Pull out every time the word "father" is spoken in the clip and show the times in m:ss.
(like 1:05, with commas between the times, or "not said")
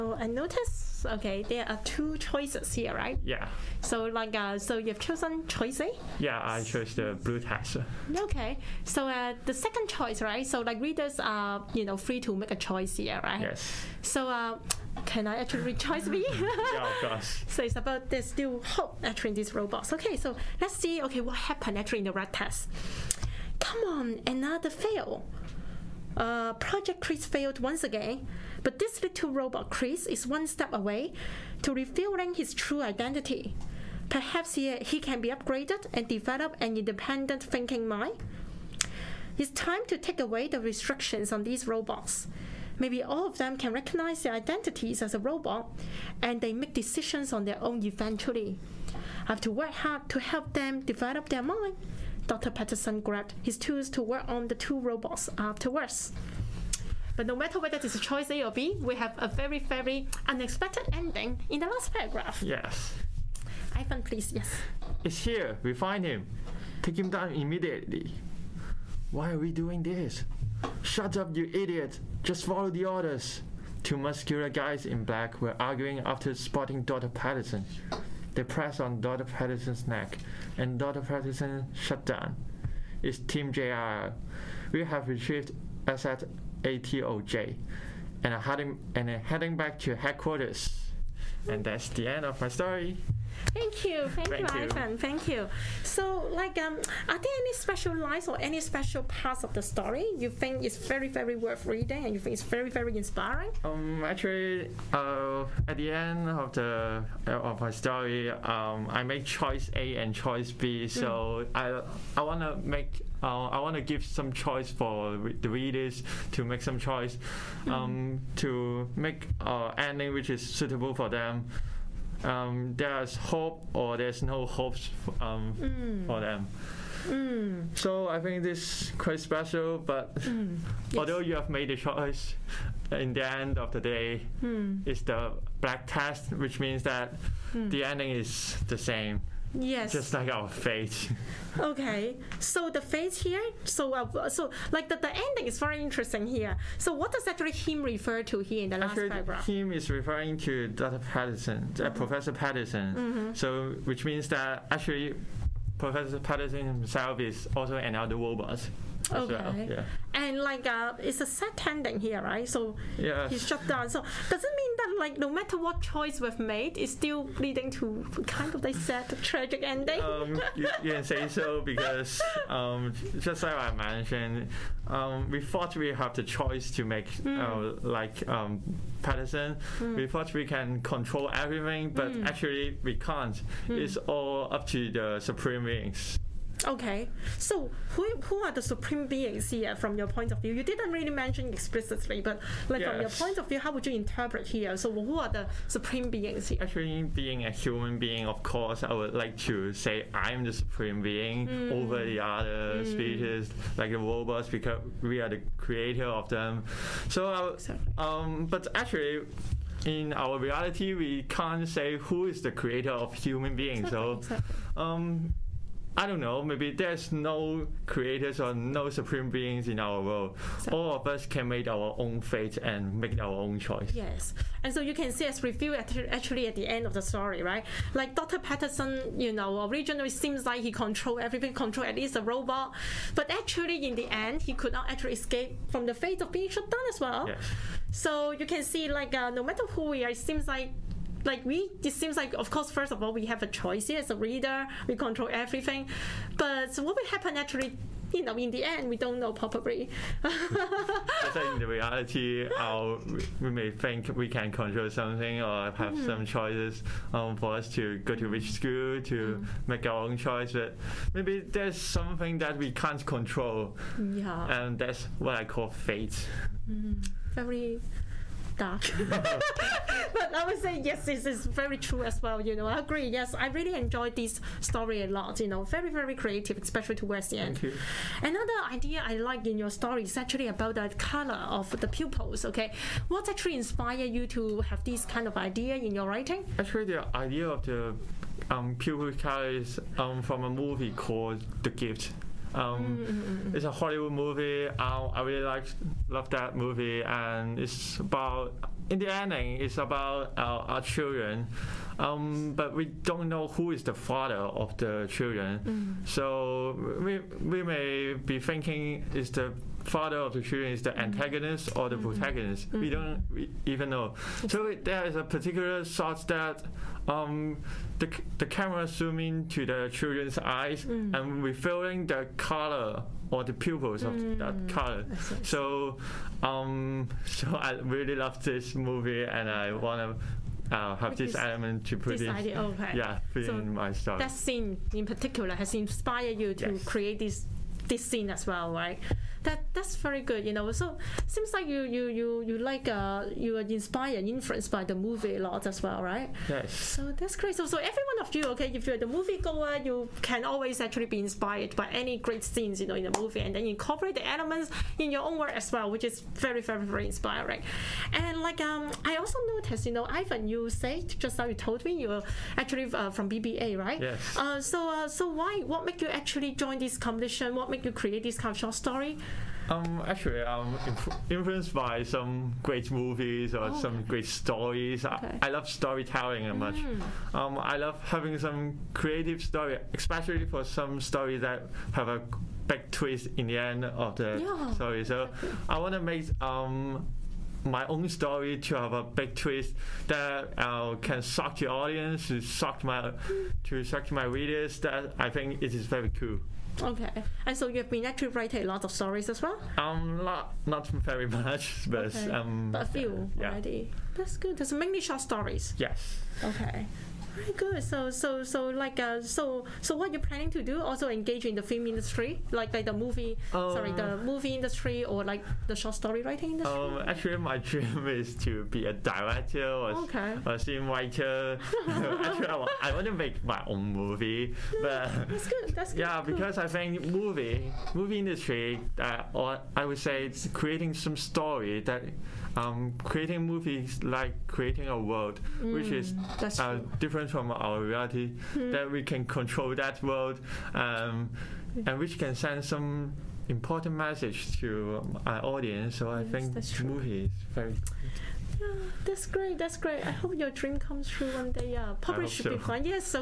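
5:03, 5:09.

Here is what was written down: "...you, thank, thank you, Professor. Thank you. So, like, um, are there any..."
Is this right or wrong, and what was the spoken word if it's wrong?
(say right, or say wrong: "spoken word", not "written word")
wrong: "Ivan", not "Professor".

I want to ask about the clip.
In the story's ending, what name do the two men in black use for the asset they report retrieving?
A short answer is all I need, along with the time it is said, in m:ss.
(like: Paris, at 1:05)
ATOJ, at 1:26.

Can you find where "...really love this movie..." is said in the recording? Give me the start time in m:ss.
5:27.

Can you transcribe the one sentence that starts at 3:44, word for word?
And so you can see as review at, actually at the end of the story, right?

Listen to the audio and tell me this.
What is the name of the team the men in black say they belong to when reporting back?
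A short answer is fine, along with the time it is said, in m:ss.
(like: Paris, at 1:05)
Team JR, at 1:23.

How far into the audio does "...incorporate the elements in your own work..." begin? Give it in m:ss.
5:53.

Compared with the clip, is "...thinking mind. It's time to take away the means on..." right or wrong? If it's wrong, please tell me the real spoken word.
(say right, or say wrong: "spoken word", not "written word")
wrong: "restrictions", not "means".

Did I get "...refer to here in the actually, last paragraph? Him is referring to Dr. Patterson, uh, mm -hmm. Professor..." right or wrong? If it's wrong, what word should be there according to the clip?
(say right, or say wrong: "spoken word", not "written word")
right.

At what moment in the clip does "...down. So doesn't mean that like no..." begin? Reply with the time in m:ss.
2:43.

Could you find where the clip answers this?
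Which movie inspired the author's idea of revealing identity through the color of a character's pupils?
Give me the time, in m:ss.
4:51.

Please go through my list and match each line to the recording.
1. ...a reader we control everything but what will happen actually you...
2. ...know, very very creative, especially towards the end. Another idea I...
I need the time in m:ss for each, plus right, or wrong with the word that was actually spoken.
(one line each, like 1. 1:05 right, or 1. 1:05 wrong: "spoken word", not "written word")
1. 4:04 right
2. 4:35 right.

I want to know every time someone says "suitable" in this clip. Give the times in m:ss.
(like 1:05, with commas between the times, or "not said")
2:00.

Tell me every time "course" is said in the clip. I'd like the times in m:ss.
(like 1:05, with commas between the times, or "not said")
0:17, 3:18, 4:02.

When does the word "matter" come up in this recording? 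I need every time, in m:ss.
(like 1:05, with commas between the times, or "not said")
0:57, 2:45, 3:59.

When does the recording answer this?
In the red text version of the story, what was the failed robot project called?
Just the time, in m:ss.
0:26.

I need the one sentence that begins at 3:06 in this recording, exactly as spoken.
Okay, so who, who are the supreme beings here from your point of view?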